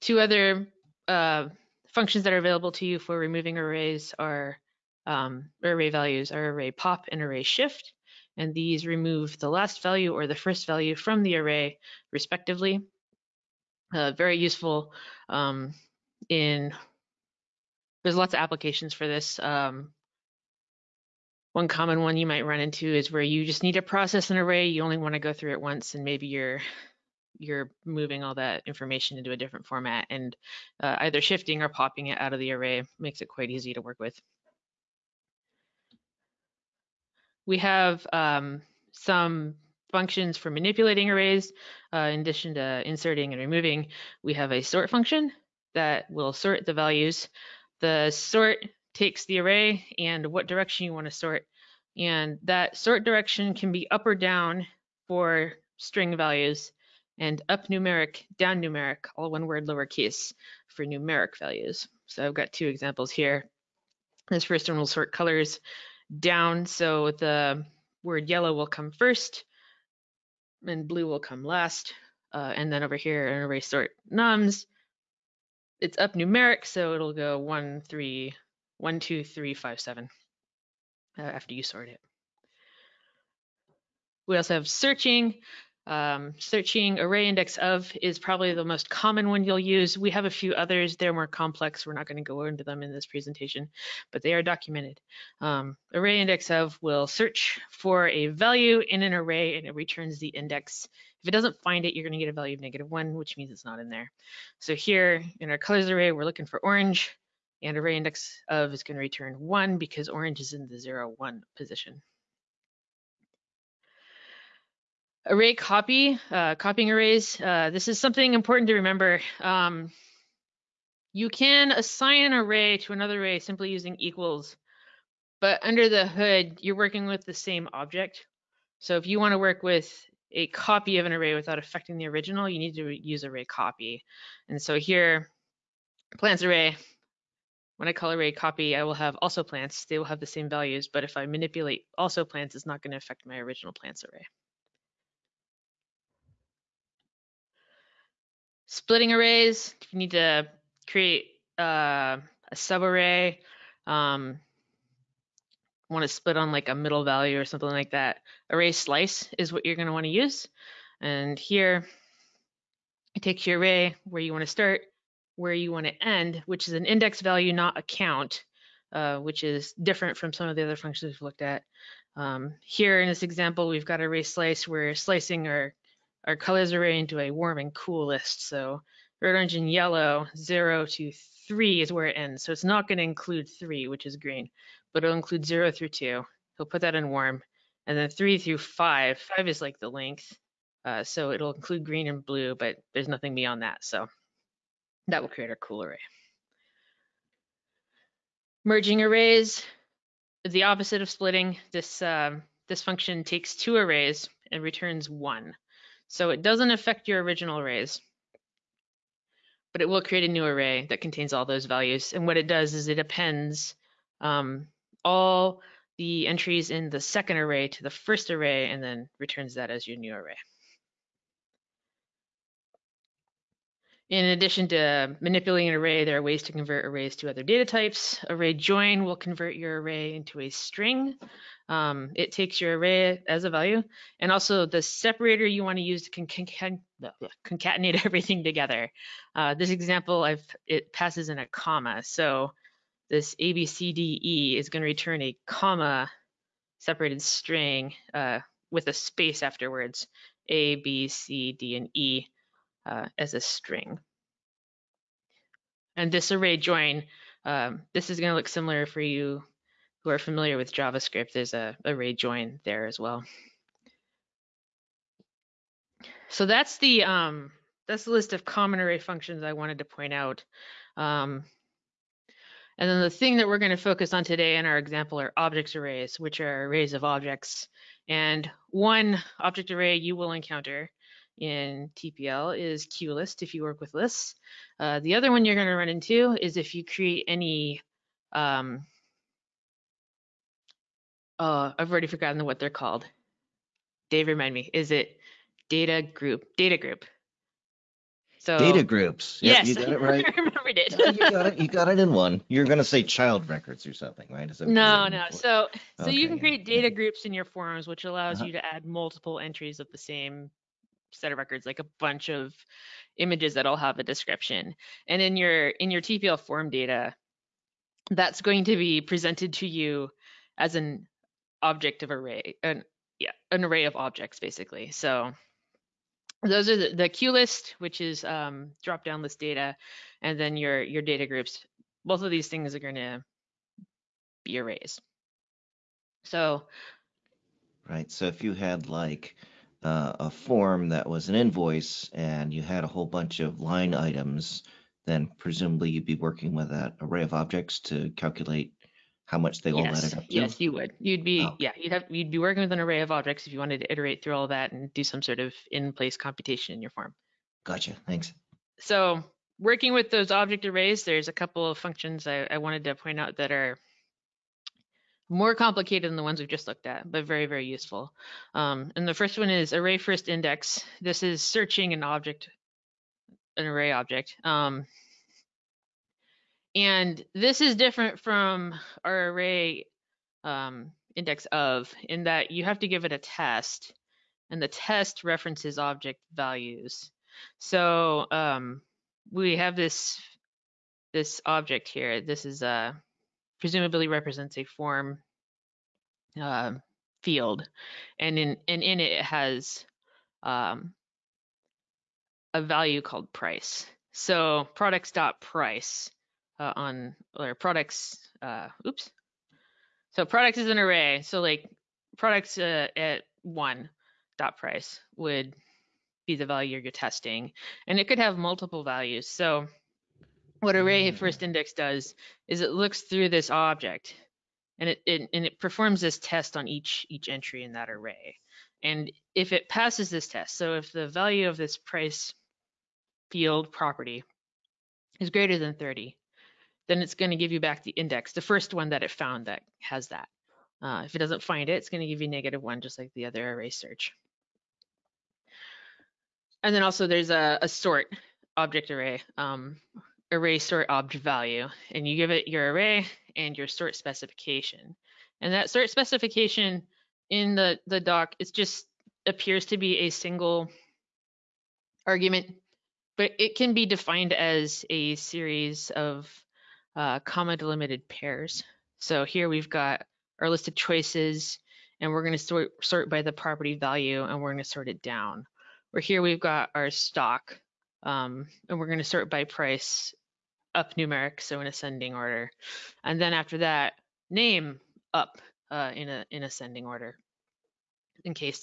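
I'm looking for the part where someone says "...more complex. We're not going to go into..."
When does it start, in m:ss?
1:31.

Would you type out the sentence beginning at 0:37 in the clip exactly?
We have um, some functions for manipulating arrays.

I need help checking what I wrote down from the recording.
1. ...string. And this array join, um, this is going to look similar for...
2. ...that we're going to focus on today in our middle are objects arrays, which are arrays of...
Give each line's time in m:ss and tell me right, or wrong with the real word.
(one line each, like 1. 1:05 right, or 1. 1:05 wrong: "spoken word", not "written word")
1. 4:13 right
2. 4:33 wrong: "example", not "middle".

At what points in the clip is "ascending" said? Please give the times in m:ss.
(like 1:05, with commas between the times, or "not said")
8:01, 8:06.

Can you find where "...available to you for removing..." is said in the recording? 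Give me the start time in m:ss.
0:02.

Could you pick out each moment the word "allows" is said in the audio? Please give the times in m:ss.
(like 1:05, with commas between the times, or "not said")
5:08.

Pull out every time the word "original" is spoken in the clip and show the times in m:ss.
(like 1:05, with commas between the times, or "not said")
2:12, 2:23, 3:27.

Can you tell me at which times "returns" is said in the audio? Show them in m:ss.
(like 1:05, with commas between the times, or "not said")
1:39, 1:49, 3:24, 3:39, 4:04.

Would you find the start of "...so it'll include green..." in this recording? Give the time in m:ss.
3:11.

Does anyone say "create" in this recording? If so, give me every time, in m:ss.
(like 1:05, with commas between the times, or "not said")
2:30, 3:15, 3:30, 4:46, 5:06.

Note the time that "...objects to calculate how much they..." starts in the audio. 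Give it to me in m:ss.
5:47.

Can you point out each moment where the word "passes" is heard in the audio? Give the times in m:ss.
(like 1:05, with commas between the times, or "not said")
4:00, 7:09.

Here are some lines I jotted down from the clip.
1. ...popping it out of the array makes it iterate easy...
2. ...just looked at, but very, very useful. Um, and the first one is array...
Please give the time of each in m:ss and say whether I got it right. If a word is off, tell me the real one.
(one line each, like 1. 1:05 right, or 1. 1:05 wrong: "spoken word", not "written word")
1. 0:31 wrong: "quite", not "iterate"
2. 6:06 right.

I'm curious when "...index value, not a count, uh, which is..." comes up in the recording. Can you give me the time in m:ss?
2:46.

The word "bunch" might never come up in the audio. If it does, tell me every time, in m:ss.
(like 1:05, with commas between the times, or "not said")
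5:11, 5:43.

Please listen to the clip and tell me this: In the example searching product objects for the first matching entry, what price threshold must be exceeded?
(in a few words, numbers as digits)
30.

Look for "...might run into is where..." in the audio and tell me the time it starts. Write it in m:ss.
0:22.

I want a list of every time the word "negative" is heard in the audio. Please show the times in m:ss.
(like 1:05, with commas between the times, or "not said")
1:42, 7:22.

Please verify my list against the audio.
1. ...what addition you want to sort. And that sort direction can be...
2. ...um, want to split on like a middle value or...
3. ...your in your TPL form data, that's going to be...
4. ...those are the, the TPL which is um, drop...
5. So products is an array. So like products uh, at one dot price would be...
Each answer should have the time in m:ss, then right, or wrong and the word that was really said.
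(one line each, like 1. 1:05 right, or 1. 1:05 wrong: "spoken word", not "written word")
1. 0:50 wrong: "direction", not "addition"
2. 2:33 right
3. 5:15 right
4. 5:26 wrong: "QList", not "TPL"
5. 6:50 right.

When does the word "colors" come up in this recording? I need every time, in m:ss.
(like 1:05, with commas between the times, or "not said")
1:05, 1:45, 2:56.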